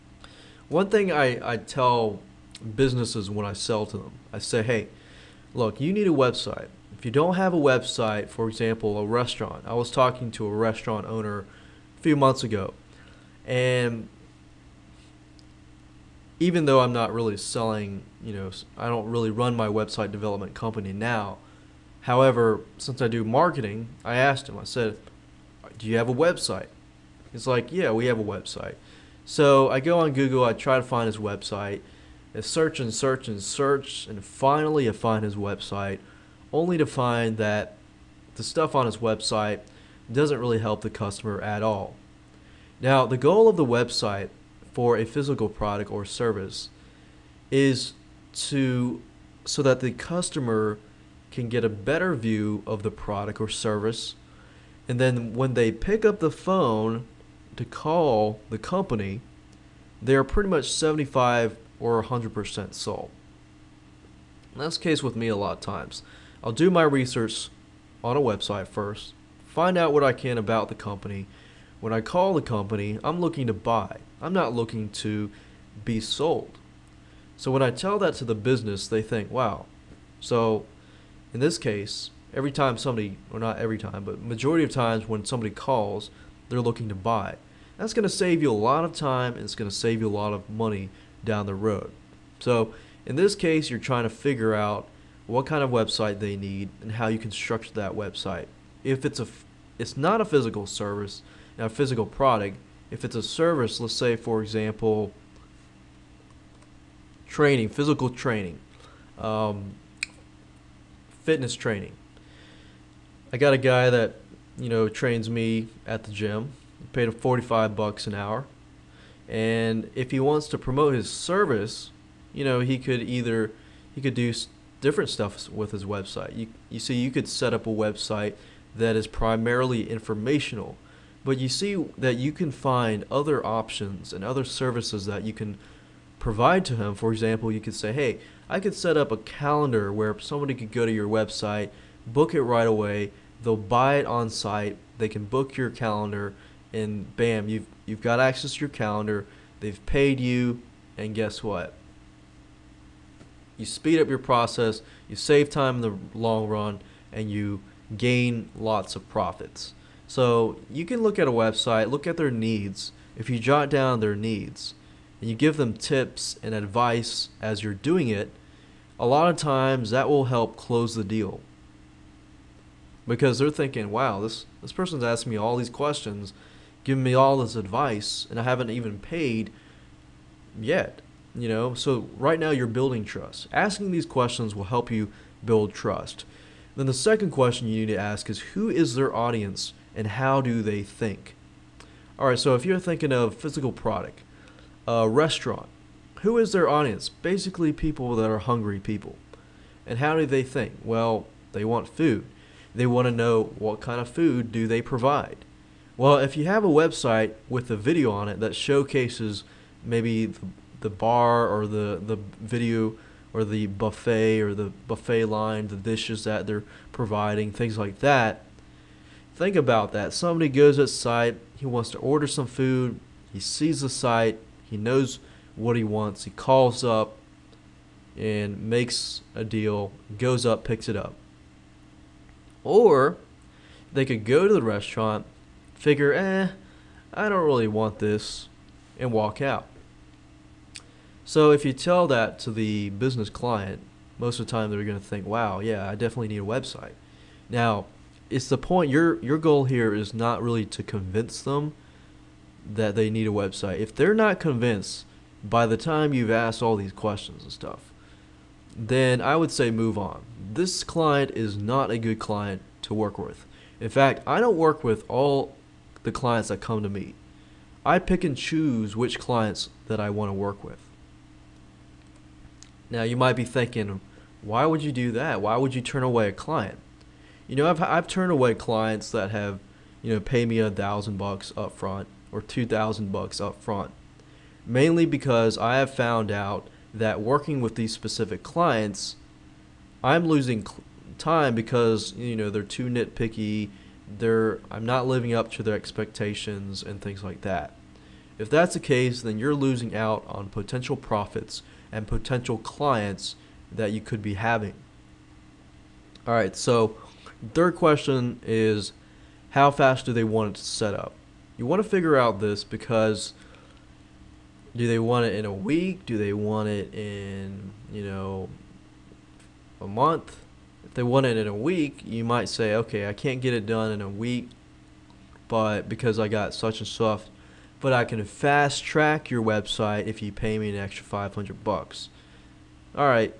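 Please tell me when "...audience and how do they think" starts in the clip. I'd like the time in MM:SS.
03:09.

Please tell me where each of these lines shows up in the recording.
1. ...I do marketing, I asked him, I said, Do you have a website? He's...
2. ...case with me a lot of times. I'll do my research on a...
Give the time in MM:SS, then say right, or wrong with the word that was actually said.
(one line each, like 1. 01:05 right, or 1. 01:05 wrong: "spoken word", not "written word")
1. 00:23 right
2. 01:04 right.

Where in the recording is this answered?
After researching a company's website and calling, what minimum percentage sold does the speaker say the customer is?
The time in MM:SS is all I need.
01:00.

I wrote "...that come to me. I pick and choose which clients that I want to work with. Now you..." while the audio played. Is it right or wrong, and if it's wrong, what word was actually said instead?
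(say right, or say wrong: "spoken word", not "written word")
right.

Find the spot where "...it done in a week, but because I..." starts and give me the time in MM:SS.
05:23.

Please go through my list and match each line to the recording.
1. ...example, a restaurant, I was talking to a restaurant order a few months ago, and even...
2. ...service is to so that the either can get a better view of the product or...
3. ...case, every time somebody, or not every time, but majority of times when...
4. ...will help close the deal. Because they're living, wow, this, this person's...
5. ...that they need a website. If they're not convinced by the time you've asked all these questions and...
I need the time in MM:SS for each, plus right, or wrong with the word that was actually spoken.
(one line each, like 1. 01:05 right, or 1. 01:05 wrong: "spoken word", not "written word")
1. 00:08 wrong: "owner", not "order"
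2. 00:46 wrong: "customer", not "either"
3. 01:21 right
4. 02:50 wrong: "thinking", not "living"
5. 04:12 right.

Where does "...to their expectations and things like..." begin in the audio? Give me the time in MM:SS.
04:55.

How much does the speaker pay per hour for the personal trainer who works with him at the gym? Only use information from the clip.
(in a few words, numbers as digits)
$45.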